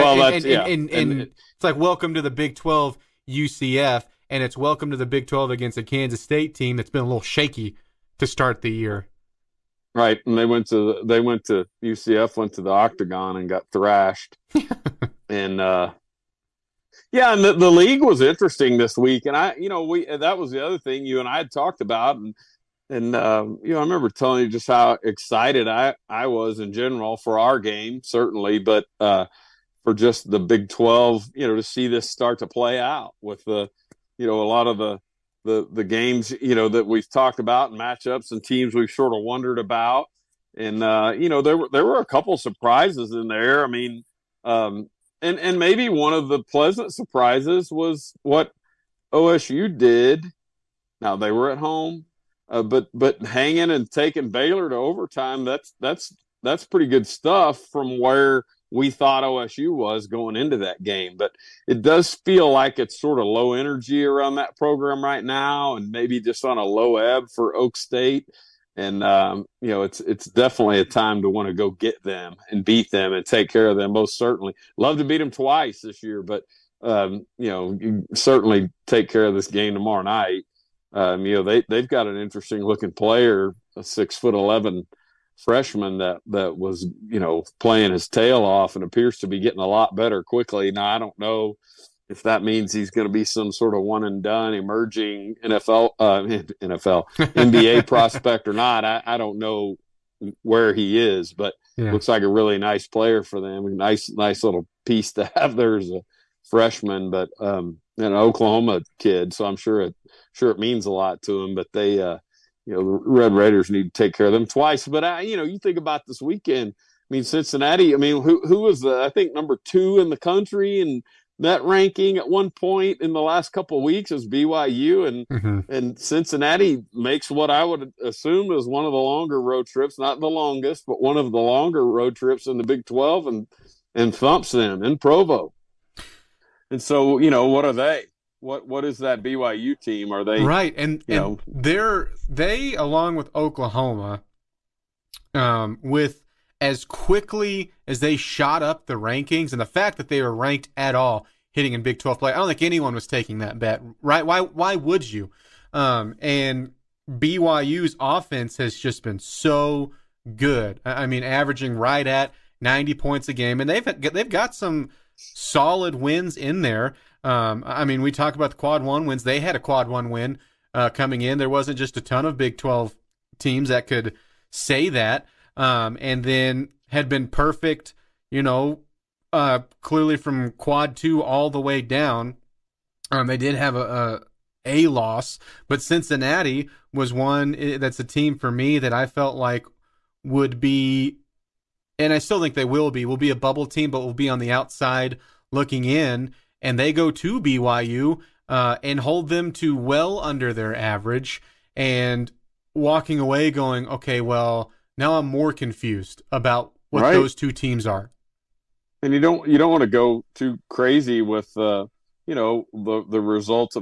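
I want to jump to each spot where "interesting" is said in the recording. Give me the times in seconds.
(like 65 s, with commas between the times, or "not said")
18 s, 82 s.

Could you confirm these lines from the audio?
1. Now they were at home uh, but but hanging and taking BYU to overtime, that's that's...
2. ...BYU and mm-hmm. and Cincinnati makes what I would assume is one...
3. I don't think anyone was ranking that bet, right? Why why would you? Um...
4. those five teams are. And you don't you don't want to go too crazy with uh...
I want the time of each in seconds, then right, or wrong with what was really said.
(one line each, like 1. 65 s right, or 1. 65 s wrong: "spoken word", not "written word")
1. 51 s wrong: "Baylor", not "BYU"
2. 124 s right
3. 152 s wrong: "taking", not "ranking"
4. 207 s wrong: "two", not "five".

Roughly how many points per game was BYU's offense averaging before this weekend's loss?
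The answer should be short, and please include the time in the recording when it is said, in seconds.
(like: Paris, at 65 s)
90, at 162 s.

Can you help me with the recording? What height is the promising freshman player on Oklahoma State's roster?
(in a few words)
6 foot 11.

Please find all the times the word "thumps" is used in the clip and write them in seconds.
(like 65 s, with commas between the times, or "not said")
134 s.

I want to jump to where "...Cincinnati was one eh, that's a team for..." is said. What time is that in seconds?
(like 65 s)
185 s.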